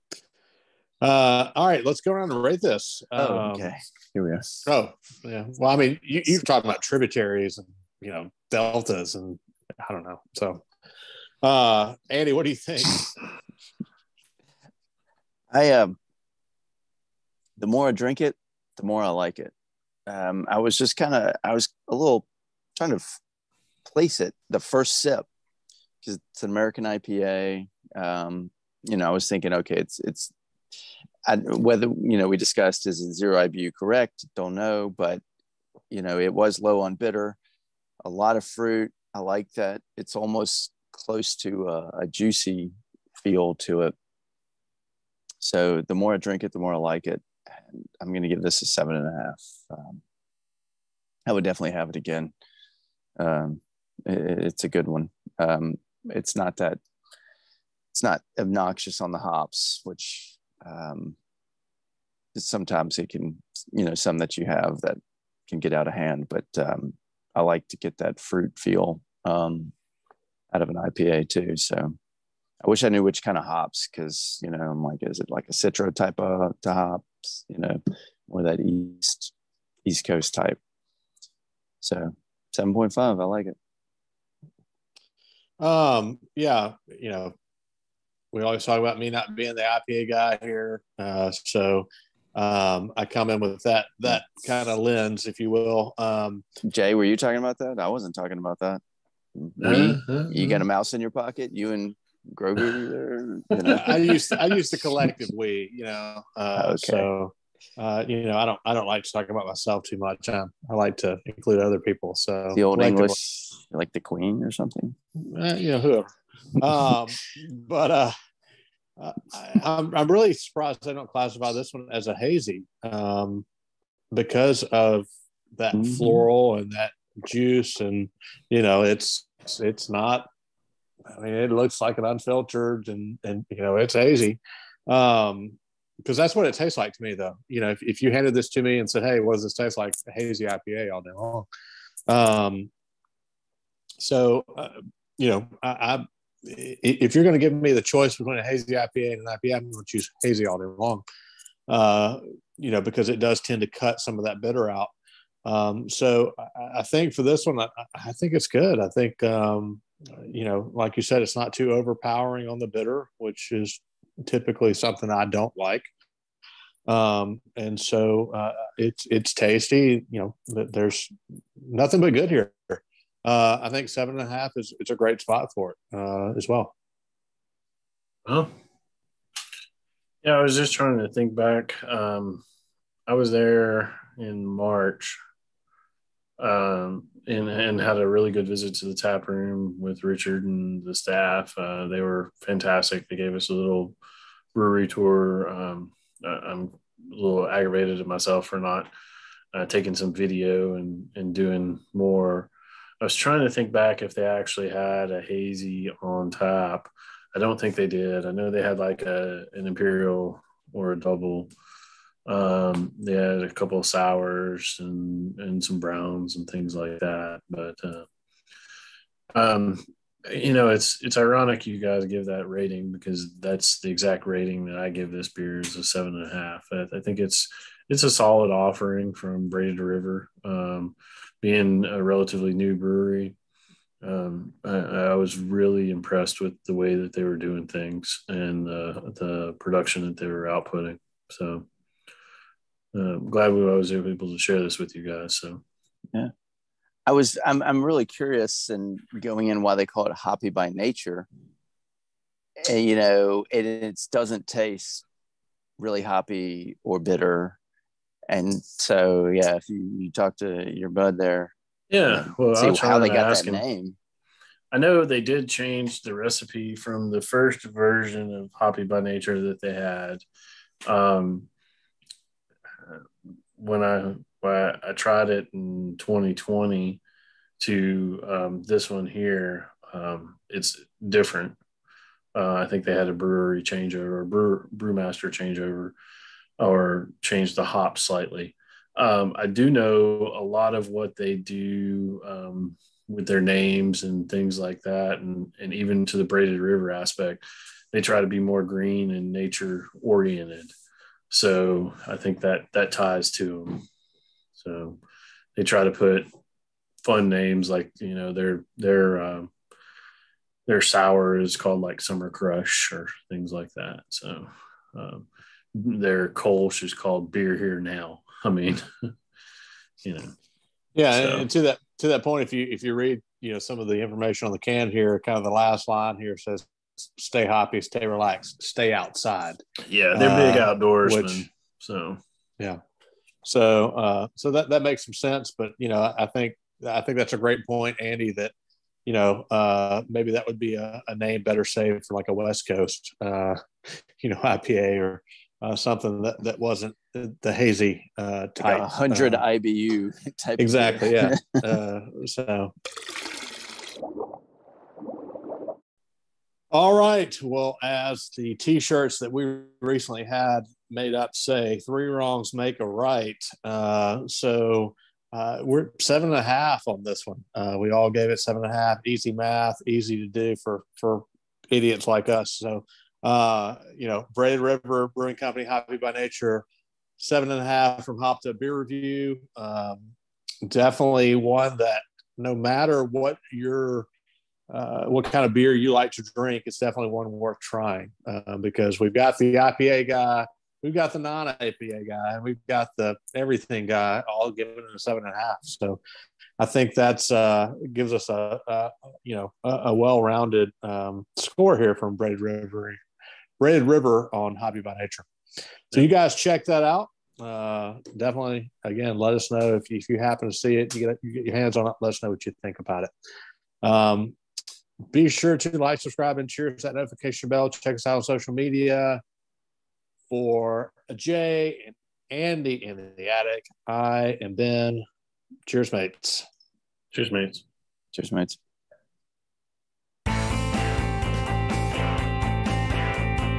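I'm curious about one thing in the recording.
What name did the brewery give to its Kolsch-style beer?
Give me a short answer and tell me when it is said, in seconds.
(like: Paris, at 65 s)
Beer Here Now, at 317 s.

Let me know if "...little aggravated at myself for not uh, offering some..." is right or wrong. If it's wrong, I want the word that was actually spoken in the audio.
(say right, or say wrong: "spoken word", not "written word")
wrong: "taking", not "offering".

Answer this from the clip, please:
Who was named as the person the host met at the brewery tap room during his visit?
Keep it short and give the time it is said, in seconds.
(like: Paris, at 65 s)
Richard, at 190 s.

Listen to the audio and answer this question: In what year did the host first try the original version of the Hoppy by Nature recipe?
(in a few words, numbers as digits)
2020.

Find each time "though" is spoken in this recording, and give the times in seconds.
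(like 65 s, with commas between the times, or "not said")
137 s.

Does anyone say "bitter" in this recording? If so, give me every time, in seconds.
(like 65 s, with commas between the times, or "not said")
36 s, 154 s, 162 s, 256 s.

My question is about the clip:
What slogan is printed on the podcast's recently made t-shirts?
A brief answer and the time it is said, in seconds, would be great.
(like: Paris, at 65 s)
Three wrongs make a right, at 361 s.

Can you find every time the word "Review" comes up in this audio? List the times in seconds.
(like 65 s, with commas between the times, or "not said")
378 s.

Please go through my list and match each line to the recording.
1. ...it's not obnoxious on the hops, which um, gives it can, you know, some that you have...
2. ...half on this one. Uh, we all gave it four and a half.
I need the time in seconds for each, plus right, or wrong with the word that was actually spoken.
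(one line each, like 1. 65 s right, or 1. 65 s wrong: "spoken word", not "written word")
1. 57 s wrong: "sometimes", not "gives"
2. 366 s wrong: "seven", not "four".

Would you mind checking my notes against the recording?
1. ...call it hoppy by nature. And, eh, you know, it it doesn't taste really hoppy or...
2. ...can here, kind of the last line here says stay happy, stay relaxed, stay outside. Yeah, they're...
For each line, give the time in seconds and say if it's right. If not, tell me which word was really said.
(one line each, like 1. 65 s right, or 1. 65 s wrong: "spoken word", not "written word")
1. 249 s right
2. 324 s right.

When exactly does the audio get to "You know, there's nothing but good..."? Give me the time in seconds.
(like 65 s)
170 s.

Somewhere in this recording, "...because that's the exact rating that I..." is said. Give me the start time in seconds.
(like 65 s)
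222 s.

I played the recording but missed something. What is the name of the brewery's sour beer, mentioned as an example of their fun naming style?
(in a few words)
Summer Crush.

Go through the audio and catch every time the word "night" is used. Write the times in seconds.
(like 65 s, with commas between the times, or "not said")
not said.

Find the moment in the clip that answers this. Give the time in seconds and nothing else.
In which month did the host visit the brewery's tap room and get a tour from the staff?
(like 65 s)
184 s.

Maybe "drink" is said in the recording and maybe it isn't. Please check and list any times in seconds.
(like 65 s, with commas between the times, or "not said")
17 s, 46 s, 386 s.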